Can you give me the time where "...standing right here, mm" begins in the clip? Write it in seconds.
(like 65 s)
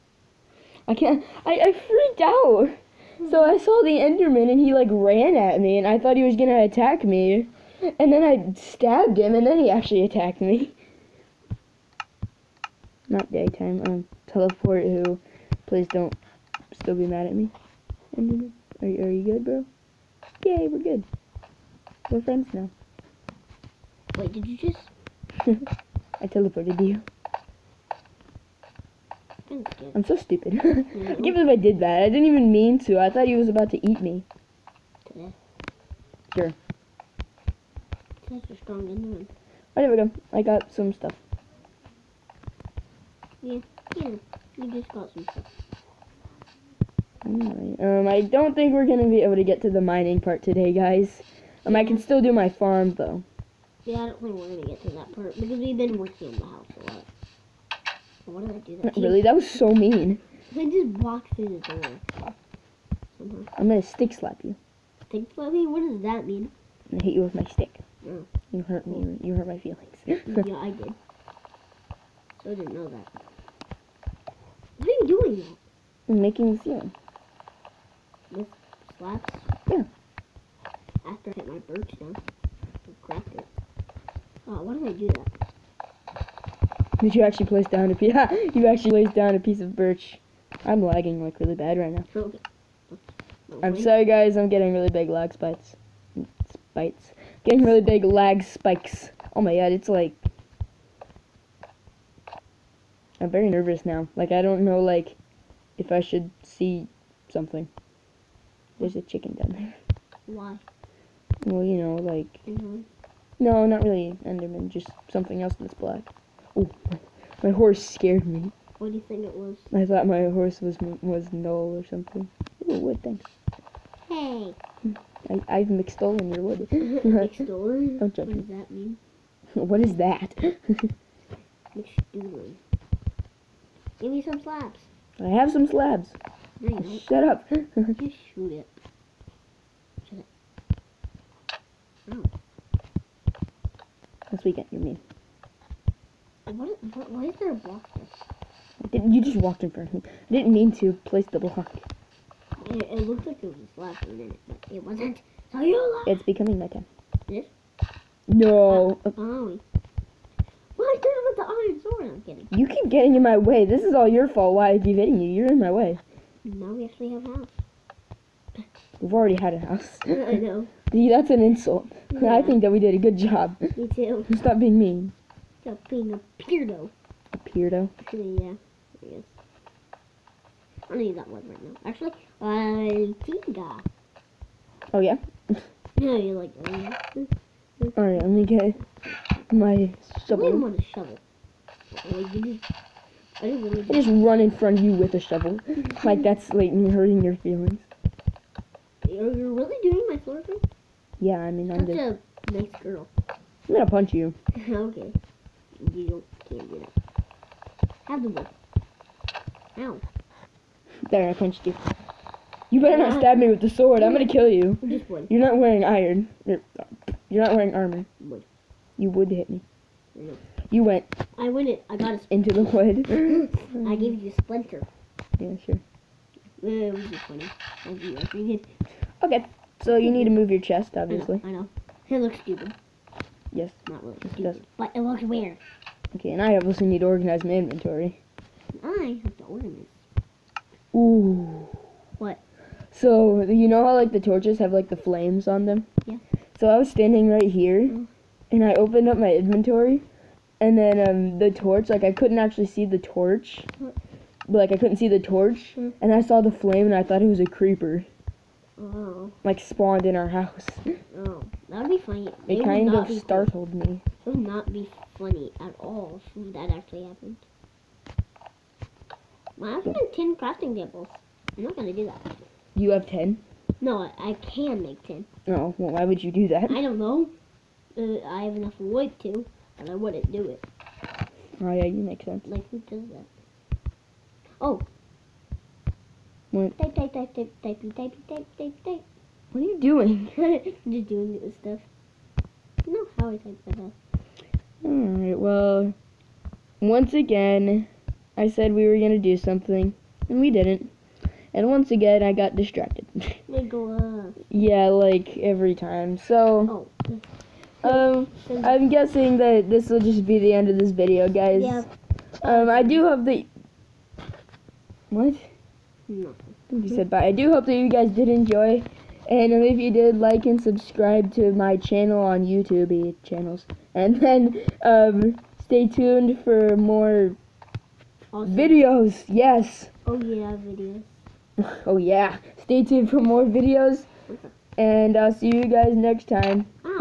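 246 s.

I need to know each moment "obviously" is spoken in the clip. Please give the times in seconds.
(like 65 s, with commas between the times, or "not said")
230 s, 236 s.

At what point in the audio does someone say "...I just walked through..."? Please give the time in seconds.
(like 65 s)
60 s.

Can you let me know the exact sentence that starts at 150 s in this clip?
I didn't mean to place the block.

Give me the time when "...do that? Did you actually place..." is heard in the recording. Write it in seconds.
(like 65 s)
84 s.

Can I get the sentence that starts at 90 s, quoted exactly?
I'm lagging like really bad right now.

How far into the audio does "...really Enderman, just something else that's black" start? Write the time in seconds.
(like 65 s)
113 s.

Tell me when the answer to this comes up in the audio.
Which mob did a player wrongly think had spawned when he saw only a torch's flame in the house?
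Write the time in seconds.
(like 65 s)
257 s.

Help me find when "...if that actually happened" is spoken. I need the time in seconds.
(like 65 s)
266 s.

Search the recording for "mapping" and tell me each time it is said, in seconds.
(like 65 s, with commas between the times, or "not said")
not said.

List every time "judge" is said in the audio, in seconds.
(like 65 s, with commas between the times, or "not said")
128 s.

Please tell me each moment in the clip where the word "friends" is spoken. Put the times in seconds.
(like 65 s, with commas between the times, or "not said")
22 s.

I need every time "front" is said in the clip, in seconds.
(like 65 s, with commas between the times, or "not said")
149 s, 194 s.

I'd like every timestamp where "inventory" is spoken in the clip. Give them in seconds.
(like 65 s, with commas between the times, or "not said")
237 s, 249 s.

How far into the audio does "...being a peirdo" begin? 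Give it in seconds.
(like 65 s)
175 s.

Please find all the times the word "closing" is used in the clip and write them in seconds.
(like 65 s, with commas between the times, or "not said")
not said.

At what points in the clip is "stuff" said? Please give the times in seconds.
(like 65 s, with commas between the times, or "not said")
40 s, 45 s, 291 s.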